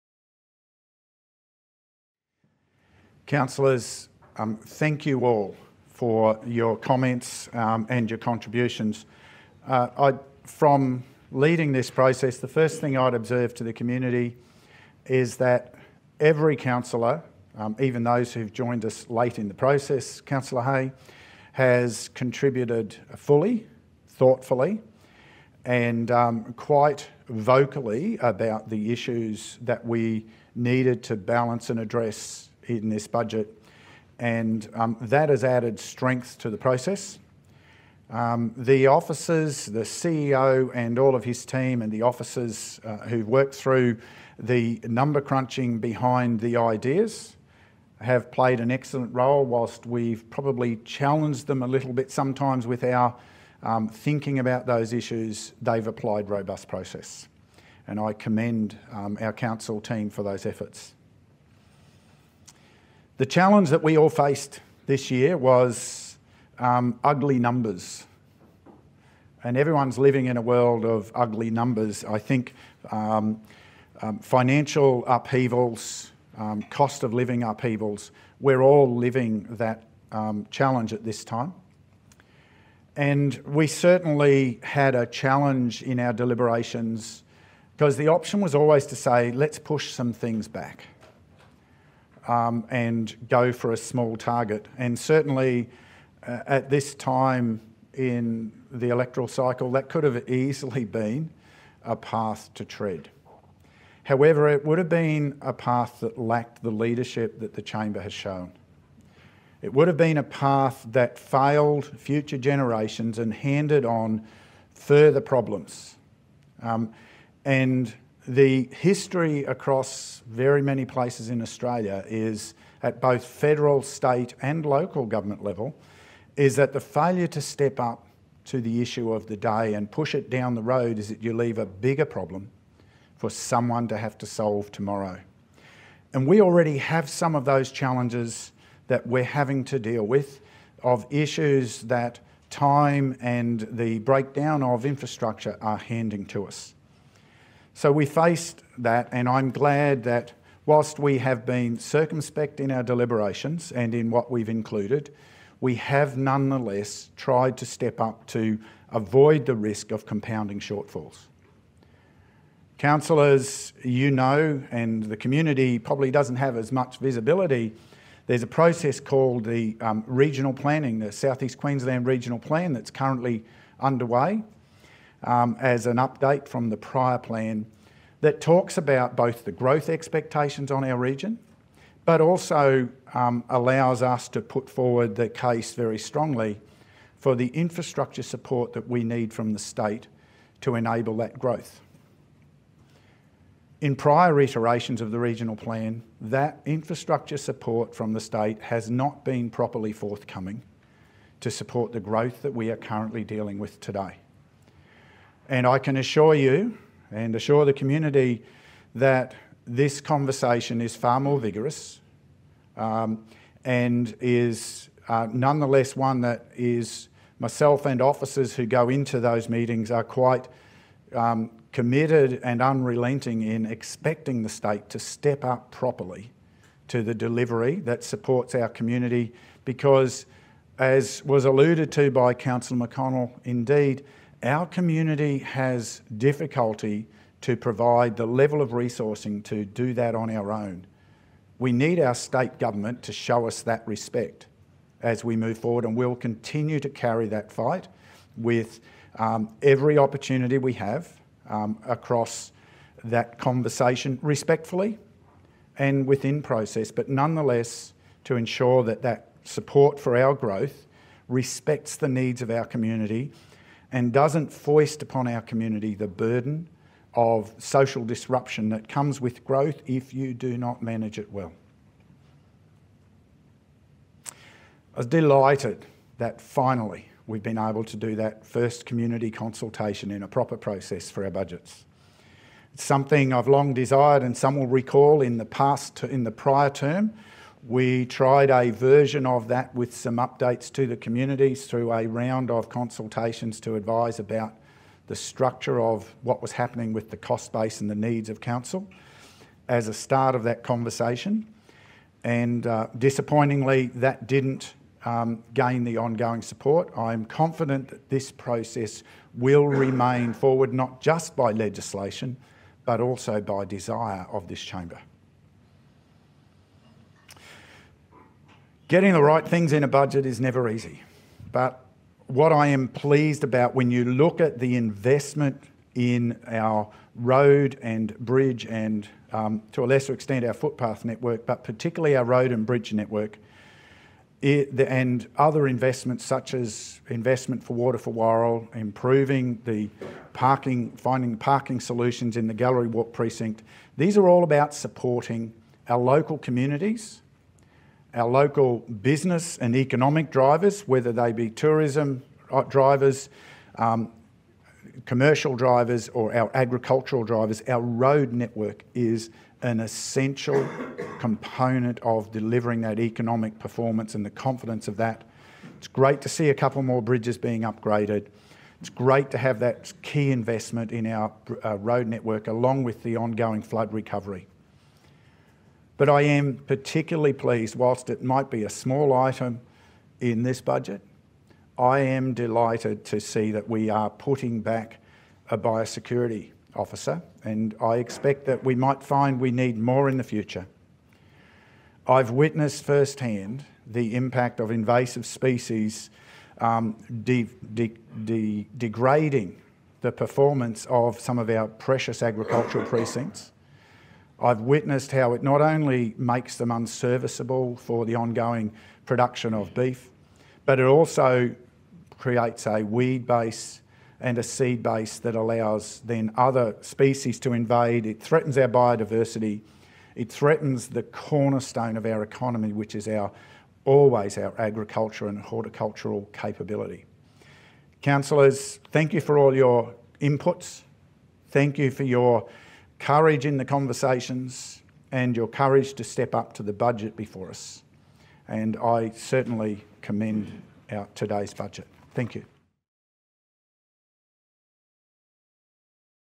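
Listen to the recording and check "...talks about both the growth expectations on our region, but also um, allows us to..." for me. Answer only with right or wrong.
right.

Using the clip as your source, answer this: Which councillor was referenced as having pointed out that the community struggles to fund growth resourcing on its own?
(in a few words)
Councillor McConnell.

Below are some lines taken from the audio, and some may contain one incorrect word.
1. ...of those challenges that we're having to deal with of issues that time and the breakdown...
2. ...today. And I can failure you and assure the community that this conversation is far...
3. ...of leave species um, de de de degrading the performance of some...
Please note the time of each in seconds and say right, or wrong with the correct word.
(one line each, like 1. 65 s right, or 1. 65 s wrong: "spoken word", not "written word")
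1. 137 s right
2. 203 s wrong: "assure", not "failure"
3. 394 s wrong: "invasive", not "leave".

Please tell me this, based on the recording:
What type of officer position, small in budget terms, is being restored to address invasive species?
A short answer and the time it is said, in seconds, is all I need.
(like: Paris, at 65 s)
biosecurity officer, at 385 s.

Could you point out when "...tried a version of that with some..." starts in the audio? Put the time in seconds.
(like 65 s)
288 s.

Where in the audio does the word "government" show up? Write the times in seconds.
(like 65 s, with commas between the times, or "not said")
125 s, 242 s.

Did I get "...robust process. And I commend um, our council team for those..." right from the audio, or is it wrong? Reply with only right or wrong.
right.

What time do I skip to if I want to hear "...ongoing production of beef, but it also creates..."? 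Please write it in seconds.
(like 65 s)
408 s.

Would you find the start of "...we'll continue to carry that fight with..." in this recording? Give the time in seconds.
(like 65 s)
245 s.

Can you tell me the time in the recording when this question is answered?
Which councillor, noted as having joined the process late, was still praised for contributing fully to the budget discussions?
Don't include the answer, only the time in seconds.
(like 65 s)
20 s.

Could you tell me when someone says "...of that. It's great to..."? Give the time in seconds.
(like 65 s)
364 s.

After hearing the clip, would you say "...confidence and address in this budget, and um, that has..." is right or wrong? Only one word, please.
wrong.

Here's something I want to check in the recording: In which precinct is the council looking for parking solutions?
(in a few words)
Gallery Walk.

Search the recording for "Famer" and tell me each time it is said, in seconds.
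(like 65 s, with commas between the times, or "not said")
not said.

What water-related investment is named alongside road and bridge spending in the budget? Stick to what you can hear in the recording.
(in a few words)
Water for Warrill.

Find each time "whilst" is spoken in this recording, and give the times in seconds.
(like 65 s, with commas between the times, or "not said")
49 s, 150 s, 377 s.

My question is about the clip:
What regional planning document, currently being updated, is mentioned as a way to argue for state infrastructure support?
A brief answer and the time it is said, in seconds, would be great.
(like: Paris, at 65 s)
Southeast Queensland Regional Plan, at 171 s.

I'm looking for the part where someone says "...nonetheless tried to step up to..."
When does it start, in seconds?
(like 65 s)
156 s.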